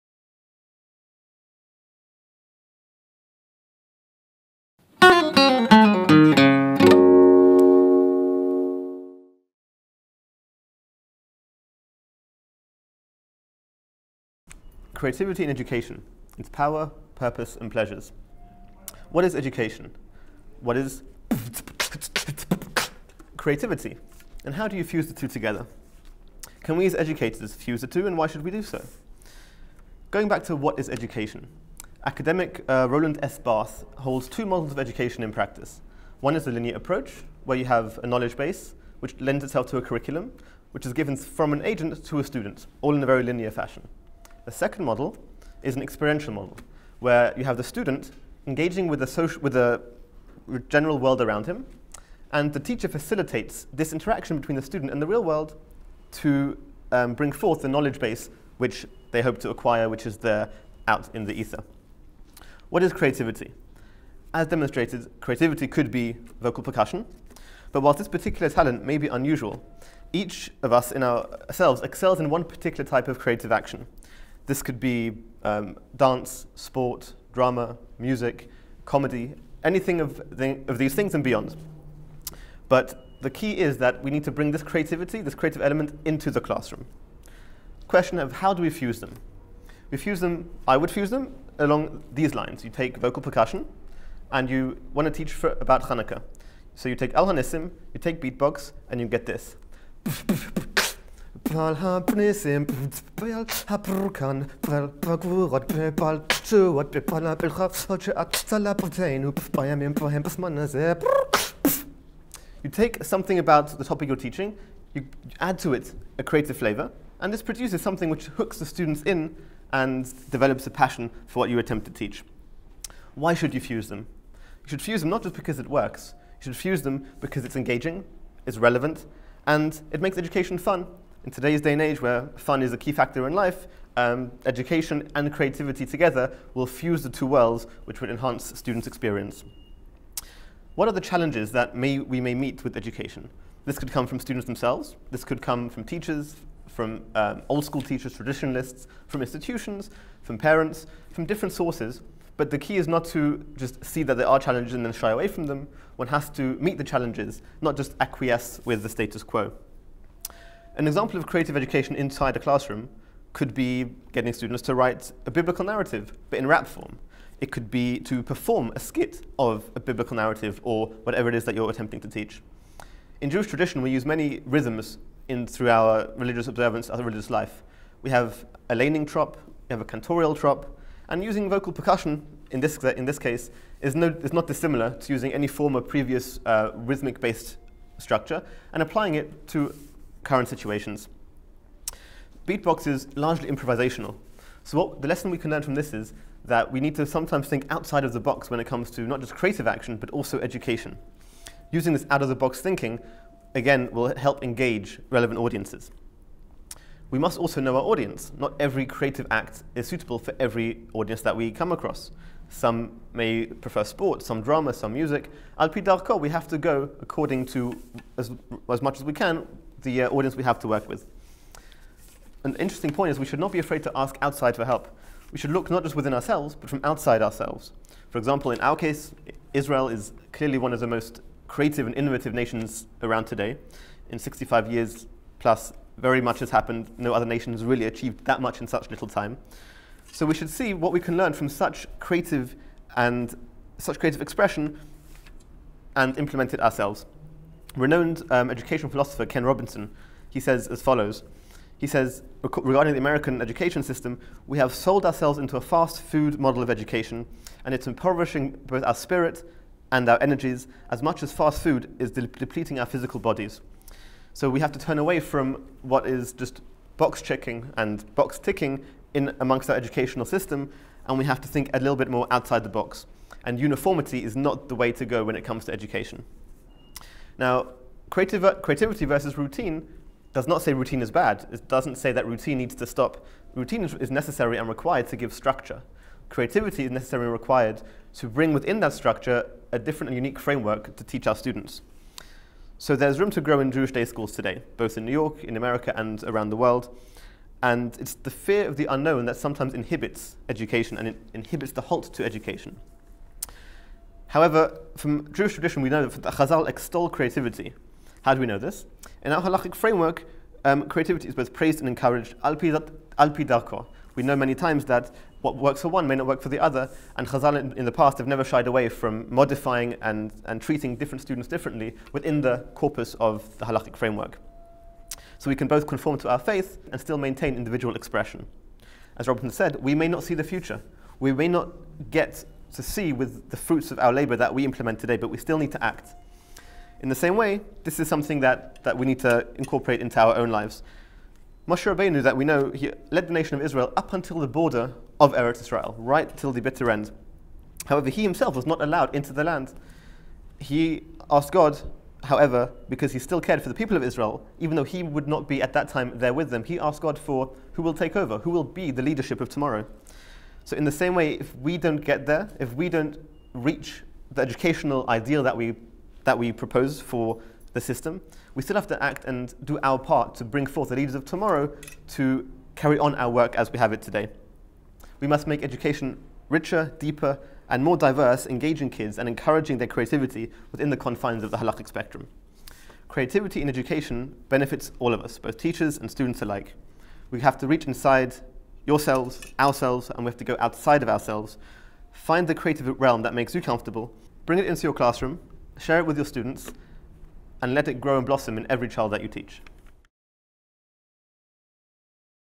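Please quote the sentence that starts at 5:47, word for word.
However, he himself was not allowed into the land.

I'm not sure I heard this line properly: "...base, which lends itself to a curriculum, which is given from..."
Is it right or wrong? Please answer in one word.
right.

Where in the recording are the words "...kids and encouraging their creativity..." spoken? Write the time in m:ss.
6:18.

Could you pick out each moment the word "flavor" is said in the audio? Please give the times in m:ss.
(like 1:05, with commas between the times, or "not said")
1:56.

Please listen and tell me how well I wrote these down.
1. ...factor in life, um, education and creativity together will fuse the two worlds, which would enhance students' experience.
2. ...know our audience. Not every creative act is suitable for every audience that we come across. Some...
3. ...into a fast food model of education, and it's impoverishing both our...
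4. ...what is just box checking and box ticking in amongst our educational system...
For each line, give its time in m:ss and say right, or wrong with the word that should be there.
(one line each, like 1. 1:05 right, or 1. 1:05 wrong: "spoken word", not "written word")
1. 2:12 right
2. 3:27 right
3. 4:15 right
4. 4:25 right.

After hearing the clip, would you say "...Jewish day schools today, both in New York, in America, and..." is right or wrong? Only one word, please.
right.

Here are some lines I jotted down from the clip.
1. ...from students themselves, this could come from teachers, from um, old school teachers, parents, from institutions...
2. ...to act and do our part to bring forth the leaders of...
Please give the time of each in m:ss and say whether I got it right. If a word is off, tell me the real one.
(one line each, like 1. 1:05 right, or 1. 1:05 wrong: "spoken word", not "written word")
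1. 2:24 wrong: "traditionalists", not "parents"
2. 6:08 right.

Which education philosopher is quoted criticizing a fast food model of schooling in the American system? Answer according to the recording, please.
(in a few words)
Ken Robinson.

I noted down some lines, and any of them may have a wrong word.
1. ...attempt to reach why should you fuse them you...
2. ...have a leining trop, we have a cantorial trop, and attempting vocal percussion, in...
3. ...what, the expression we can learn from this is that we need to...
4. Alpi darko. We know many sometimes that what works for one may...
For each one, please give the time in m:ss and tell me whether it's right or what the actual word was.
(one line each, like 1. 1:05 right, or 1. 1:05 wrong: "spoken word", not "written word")
1. 2:01 wrong: "teach", not "reach"
2. 2:58 wrong: "using", not "attempting"
3. 3:14 wrong: "lesson", not "expression"
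4. 5:12 wrong: "times", not "sometimes".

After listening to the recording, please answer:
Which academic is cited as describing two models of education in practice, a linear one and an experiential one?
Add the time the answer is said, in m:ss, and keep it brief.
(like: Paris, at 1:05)
Roland S. Barth, at 0:32.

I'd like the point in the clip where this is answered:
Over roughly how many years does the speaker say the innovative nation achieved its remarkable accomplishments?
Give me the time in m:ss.
3:54.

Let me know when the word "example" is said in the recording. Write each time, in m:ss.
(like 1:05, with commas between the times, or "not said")
2:40, 3:48.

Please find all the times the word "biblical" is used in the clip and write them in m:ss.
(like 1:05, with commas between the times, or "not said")
2:45, 2:49.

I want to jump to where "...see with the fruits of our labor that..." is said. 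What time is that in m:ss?
5:32.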